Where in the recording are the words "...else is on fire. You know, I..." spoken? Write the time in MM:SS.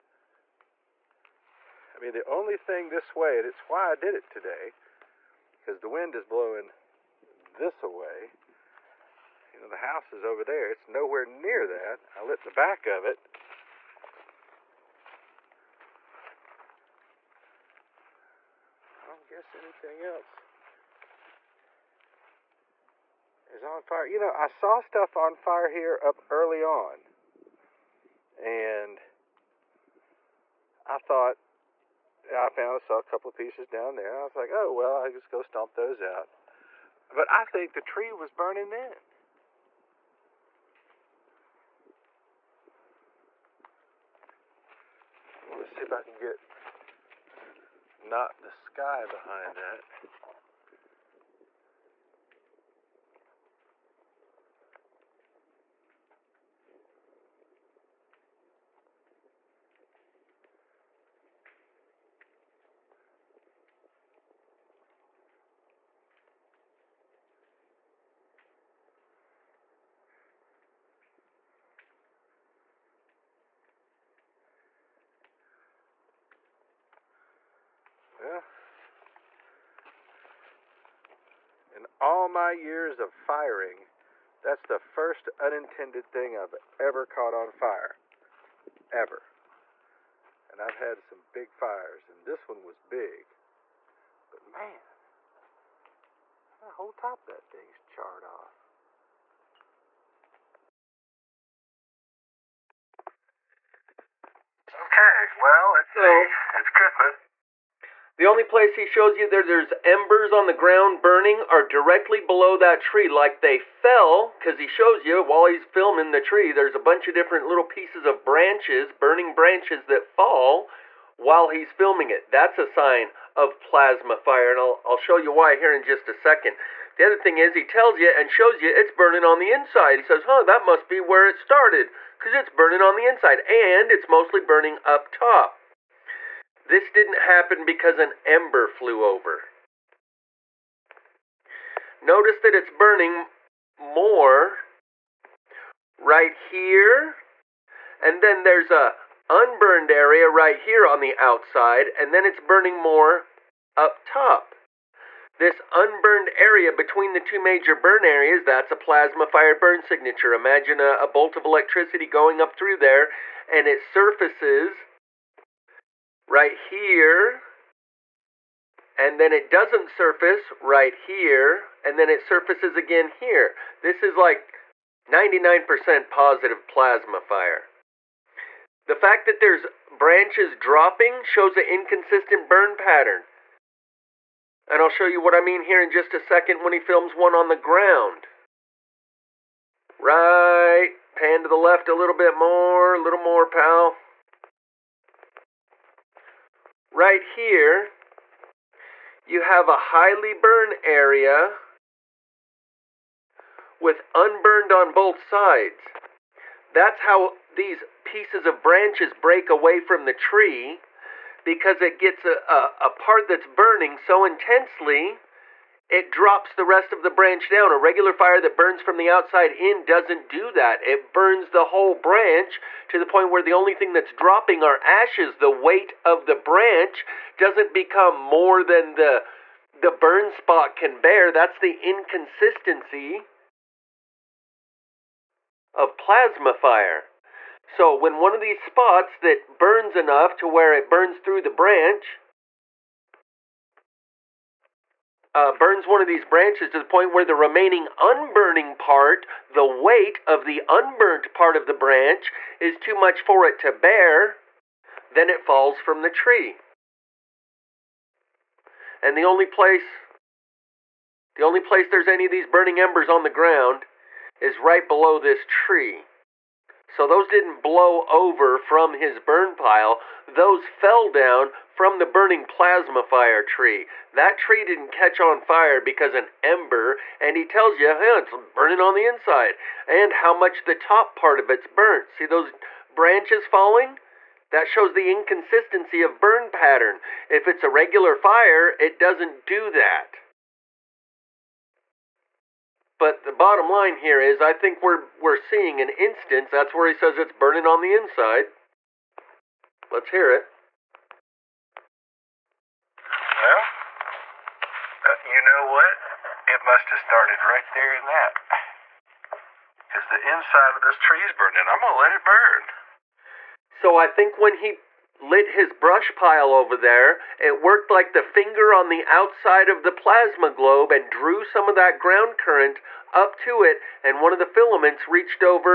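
00:20.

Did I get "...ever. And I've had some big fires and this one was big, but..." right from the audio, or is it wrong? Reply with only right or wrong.
right.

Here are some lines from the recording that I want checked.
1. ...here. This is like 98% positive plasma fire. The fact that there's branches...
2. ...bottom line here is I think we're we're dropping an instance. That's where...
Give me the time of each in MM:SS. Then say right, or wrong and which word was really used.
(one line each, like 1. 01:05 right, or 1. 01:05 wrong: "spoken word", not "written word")
1. 02:53 wrong: "99", not "98"
2. 04:53 wrong: "seeing", not "dropping".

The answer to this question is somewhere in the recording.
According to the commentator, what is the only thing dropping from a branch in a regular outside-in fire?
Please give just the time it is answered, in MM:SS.
03:44.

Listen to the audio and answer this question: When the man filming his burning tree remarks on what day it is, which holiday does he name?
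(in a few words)
Christmas.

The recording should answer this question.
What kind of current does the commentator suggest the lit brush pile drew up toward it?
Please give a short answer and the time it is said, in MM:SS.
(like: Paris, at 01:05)
Ground current, at 05:21.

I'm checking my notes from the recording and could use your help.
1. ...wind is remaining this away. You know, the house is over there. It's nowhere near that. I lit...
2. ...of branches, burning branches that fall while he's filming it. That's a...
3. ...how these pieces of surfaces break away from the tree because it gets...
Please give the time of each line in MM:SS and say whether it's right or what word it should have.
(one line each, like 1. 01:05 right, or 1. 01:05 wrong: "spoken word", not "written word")
1. 00:05 wrong: "blowing", not "remaining"
2. 01:58 right
3. 03:27 wrong: "branches", not "surfaces".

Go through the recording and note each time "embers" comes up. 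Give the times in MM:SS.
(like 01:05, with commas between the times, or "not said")
01:49, 02:18, 04:22, 04:36.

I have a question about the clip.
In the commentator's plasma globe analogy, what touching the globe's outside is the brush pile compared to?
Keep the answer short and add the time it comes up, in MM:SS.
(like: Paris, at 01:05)
The finger, at 05:18.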